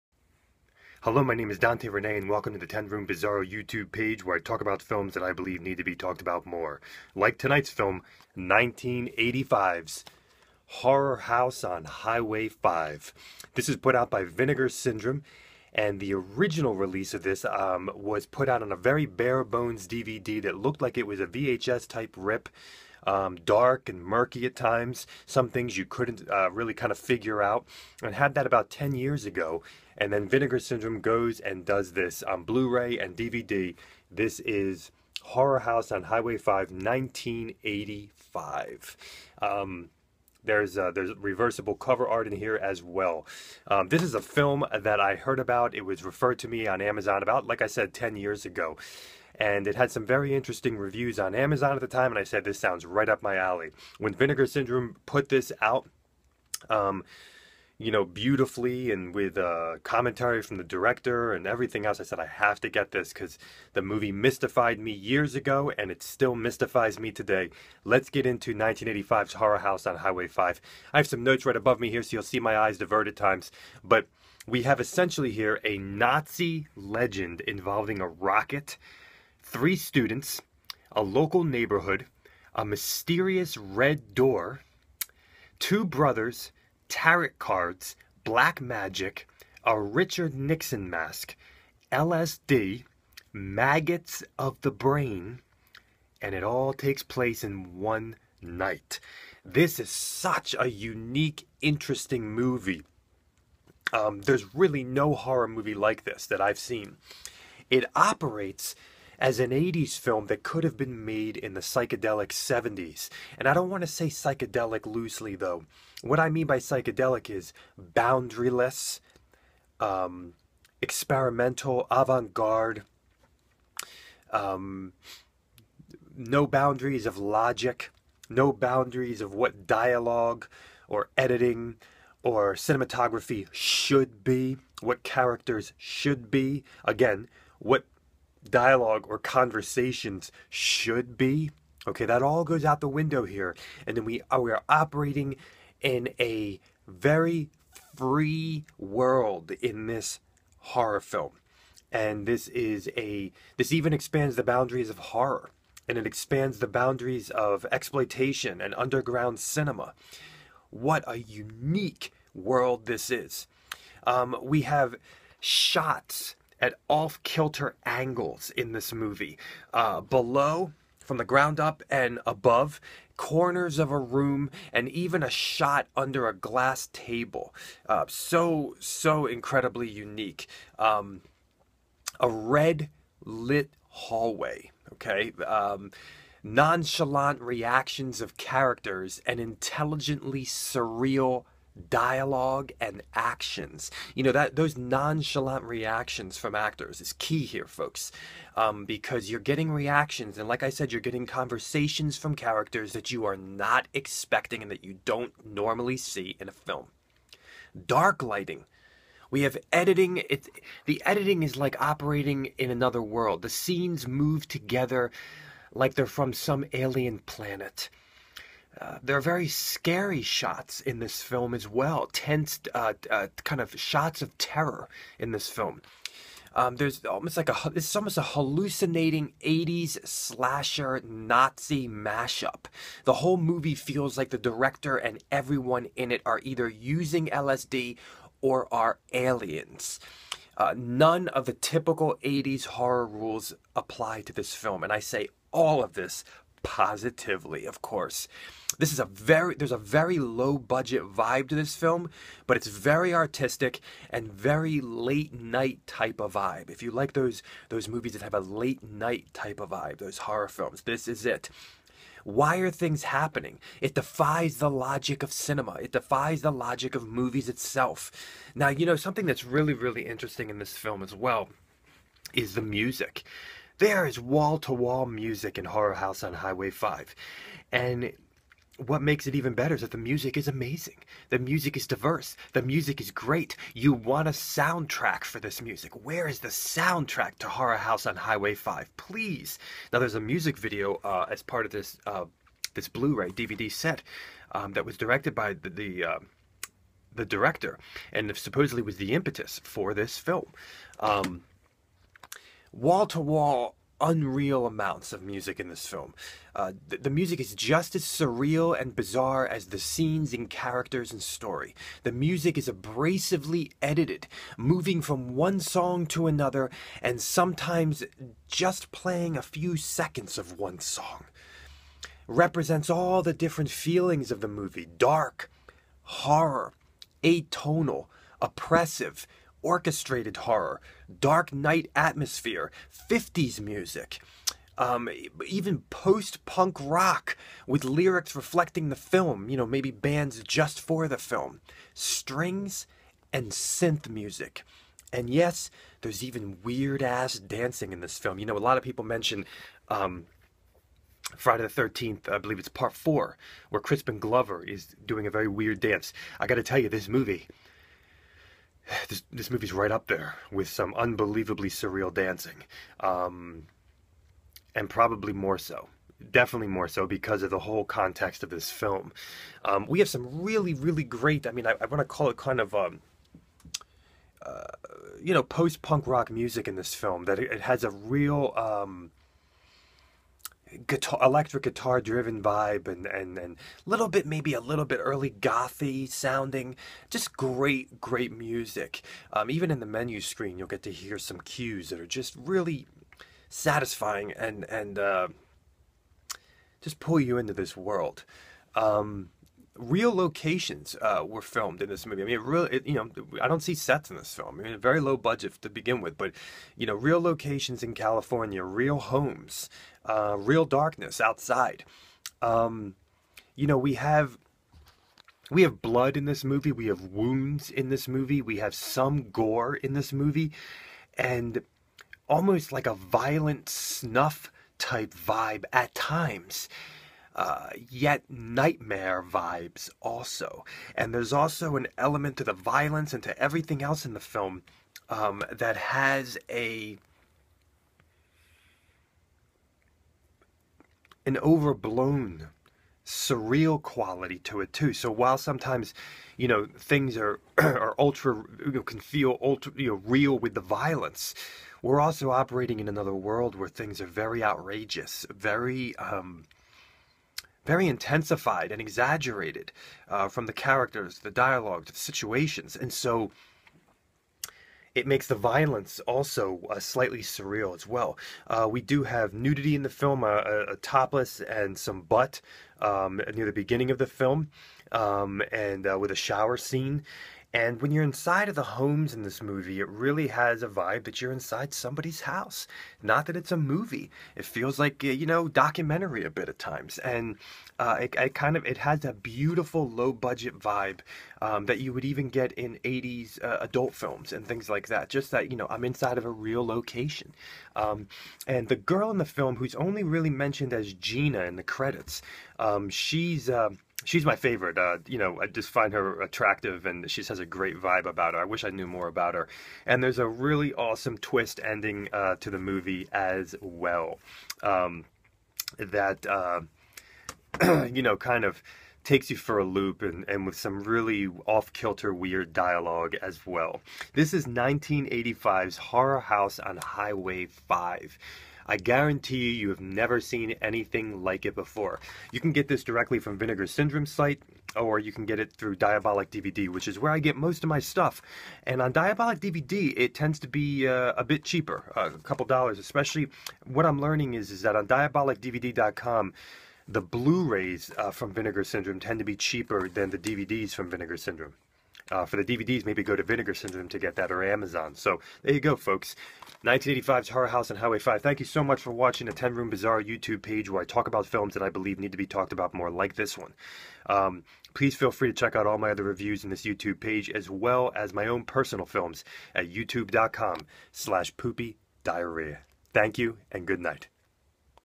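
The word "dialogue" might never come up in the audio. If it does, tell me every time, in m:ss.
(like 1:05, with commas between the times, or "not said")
2:09, 2:18, 3:11, 7:41, 8:42.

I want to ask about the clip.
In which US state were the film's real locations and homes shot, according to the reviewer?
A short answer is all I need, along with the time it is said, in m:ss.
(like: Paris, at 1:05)
California, at 6:46.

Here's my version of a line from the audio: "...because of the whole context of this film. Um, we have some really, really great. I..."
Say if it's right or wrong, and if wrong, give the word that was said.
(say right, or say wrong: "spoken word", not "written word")
right.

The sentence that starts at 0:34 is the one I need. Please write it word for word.
This is Horror House on Highway 5, 1985.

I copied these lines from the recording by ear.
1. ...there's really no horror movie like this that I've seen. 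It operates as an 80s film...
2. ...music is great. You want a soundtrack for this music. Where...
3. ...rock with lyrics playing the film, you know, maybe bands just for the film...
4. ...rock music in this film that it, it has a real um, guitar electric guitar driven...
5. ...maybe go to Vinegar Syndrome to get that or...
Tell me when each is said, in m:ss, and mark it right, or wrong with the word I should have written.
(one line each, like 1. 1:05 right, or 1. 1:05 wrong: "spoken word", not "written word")
1. 1:44 right
2. 4:42 right
3. 5:36 wrong: "reflecting", not "playing"
4. 6:16 right
5. 9:12 right.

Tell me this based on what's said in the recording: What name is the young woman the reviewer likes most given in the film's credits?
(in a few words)
Gina.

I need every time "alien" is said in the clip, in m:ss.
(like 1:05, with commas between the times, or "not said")
3:36, 3:59.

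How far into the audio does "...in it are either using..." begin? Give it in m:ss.
3:55.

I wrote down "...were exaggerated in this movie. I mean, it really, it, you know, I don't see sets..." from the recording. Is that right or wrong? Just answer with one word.
wrong.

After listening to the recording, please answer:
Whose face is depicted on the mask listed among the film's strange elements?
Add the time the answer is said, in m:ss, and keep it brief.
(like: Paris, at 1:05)
Richard Nixon, at 1:29.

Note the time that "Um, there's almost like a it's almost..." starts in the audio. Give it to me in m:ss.
3:46.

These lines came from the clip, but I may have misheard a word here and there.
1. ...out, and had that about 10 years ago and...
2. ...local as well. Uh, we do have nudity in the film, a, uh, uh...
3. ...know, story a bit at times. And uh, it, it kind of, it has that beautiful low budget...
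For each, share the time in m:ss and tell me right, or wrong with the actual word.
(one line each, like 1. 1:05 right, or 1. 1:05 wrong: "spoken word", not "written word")
1. 0:27 right
2. 7:47 wrong: "surreal", not "local"
3. 8:05 wrong: "documentary", not "story".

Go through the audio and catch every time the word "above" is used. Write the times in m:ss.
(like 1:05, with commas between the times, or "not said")
1:11, 2:52.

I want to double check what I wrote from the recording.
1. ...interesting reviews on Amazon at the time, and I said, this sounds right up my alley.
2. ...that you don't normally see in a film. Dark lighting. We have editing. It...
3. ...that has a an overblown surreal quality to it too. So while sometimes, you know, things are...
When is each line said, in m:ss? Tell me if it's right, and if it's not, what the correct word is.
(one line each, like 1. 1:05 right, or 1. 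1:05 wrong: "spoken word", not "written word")
1. 0:50 right
2. 3:24 right
3. 7:15 right.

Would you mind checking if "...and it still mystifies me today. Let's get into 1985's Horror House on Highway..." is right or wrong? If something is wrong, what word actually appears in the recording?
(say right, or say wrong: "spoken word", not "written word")
right.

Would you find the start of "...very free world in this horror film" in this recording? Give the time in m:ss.
2:26.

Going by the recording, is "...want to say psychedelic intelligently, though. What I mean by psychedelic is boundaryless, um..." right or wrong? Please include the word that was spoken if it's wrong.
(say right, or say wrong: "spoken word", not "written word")
wrong: "loosely", not "intelligently".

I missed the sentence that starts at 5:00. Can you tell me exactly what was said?
Um, wall to wall, unreal amounts of music in this film.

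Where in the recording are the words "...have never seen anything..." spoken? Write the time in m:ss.
8:49.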